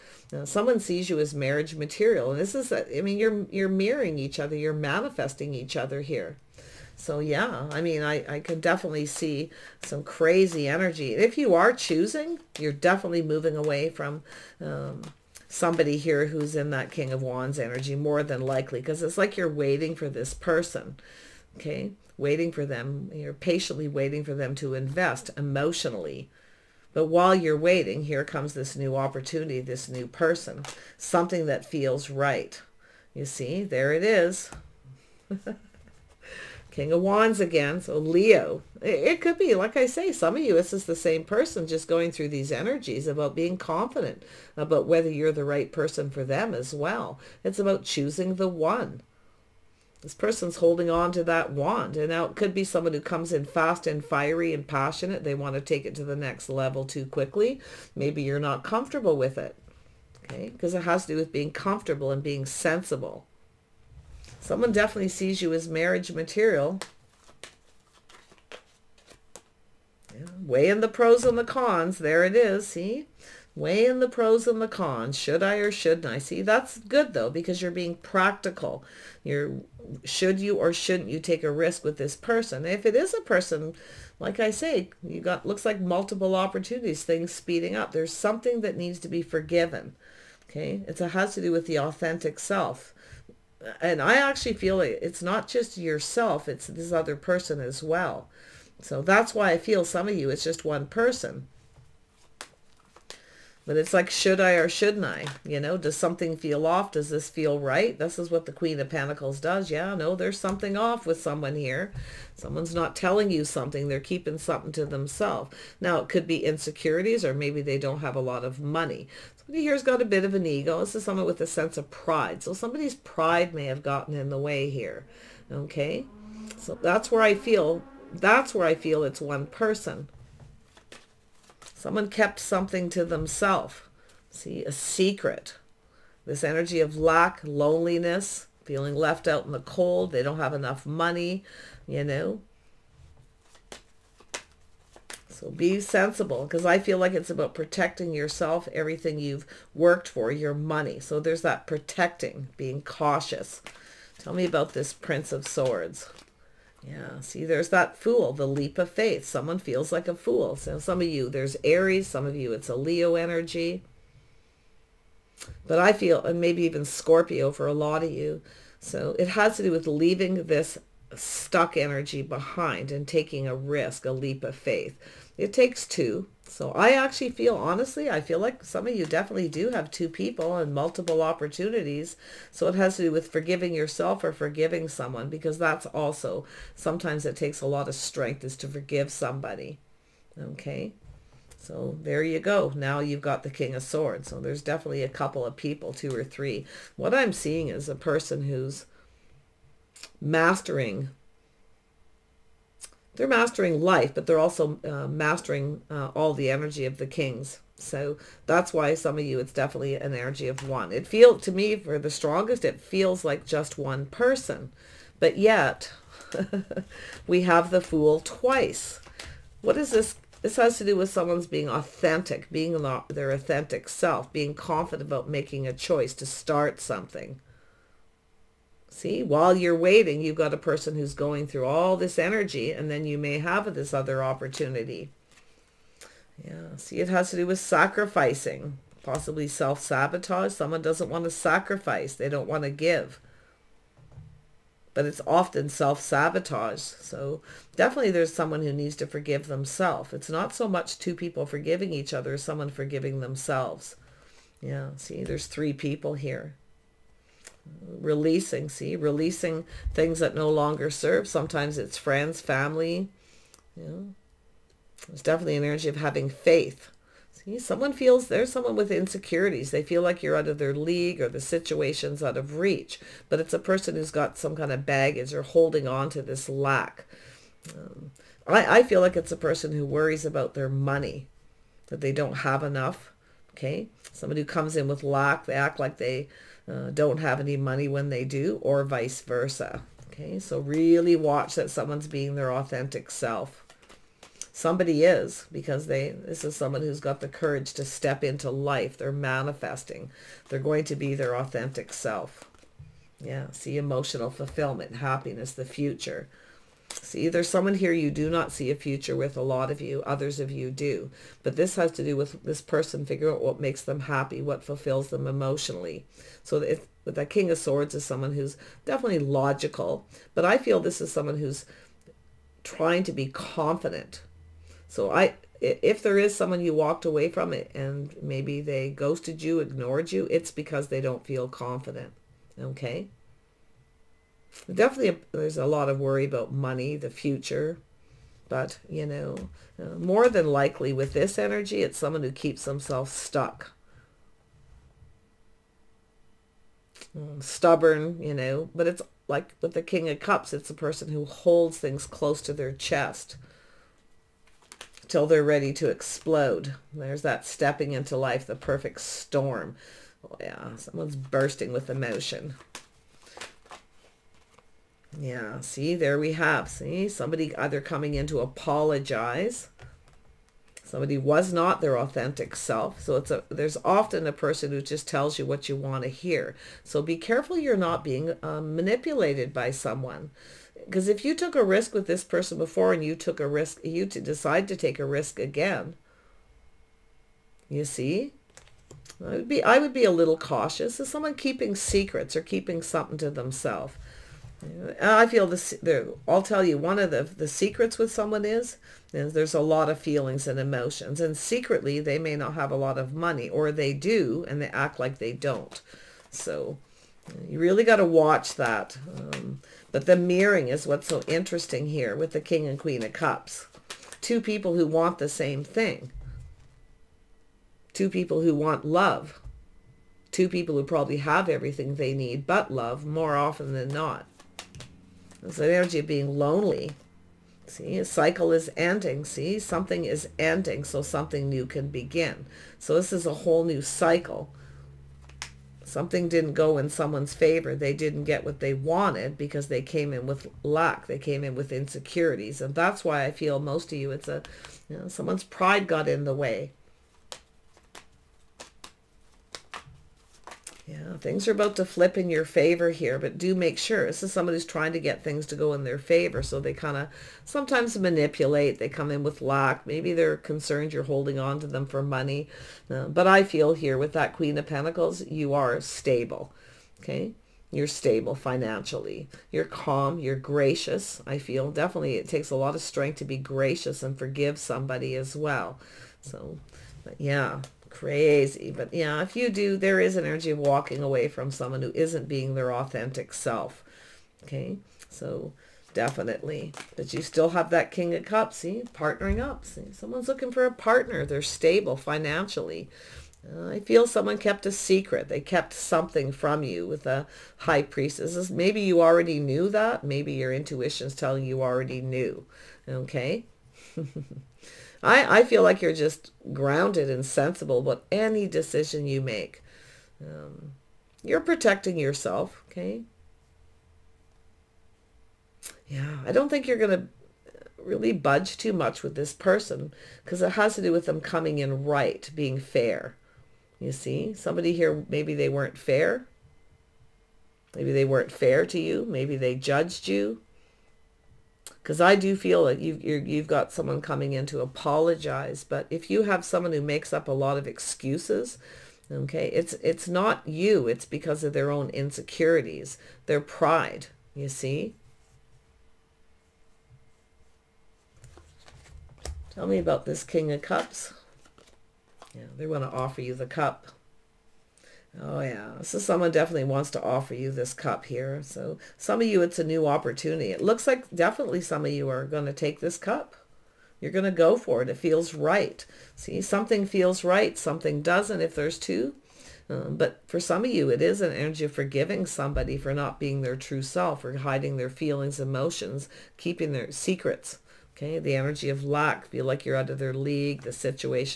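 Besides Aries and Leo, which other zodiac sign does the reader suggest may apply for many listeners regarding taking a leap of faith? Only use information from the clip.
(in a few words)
Scorpio.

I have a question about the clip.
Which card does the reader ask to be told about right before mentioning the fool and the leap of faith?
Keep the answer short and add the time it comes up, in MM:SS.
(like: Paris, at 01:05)
Prince of Swords, at 02:34.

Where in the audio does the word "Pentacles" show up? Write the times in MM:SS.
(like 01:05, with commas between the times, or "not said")
01:48, 07:44.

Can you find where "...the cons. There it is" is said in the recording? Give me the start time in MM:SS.
01:11.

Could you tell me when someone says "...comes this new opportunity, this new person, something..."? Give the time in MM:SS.
00:28.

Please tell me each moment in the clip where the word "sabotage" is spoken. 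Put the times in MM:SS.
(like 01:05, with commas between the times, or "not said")
03:59, 04:05.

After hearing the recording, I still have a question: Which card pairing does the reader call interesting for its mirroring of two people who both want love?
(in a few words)
King and Queen of Cups.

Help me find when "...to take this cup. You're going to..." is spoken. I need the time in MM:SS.
09:22.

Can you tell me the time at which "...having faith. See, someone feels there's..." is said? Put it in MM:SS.
04:25.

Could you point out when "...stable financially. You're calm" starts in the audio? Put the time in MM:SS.
07:47.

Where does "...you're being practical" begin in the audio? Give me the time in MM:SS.
01:17.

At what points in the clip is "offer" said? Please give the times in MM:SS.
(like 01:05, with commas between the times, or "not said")
09:12, 09:17.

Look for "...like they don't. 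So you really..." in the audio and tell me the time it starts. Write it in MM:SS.
06:44.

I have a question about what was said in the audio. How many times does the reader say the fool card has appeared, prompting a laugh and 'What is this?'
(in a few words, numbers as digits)
Twice.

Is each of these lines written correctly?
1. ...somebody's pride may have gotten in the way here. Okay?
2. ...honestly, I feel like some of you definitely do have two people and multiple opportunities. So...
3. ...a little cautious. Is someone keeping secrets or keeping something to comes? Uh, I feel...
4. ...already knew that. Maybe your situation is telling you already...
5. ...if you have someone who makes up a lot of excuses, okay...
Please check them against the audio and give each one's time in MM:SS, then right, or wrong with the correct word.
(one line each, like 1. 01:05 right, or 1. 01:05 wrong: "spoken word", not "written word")
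1. 02:02 right
2. 02:57 right
3. 06:30 wrong: "themselves", not "comes"
4. 08:19 wrong: "intuition", not "situation"
5. 08:55 right.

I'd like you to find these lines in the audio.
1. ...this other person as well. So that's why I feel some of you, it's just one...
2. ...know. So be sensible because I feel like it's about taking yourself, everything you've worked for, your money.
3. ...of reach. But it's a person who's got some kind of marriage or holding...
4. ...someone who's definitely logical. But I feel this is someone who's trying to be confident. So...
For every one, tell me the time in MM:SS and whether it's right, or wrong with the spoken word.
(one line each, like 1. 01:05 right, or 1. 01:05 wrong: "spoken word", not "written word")
1. 01:36 right
2. 02:22 wrong: "protecting", not "taking"
3. 04:32 wrong: "baggage", not "marriage"
4. 05:18 right.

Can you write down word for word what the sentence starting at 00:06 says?
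So yeah, I mean, I I can definitely see some crazy energy.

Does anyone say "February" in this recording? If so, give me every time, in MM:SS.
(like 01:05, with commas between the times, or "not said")
not said.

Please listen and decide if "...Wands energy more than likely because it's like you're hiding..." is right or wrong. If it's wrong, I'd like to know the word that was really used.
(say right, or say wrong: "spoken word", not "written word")
wrong: "waiting", not "hiding".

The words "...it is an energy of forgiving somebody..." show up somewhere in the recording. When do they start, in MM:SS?
09:30.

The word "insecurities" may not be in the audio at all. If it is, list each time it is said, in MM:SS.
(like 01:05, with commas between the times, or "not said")
01:56, 04:28, 07:21, 09:01.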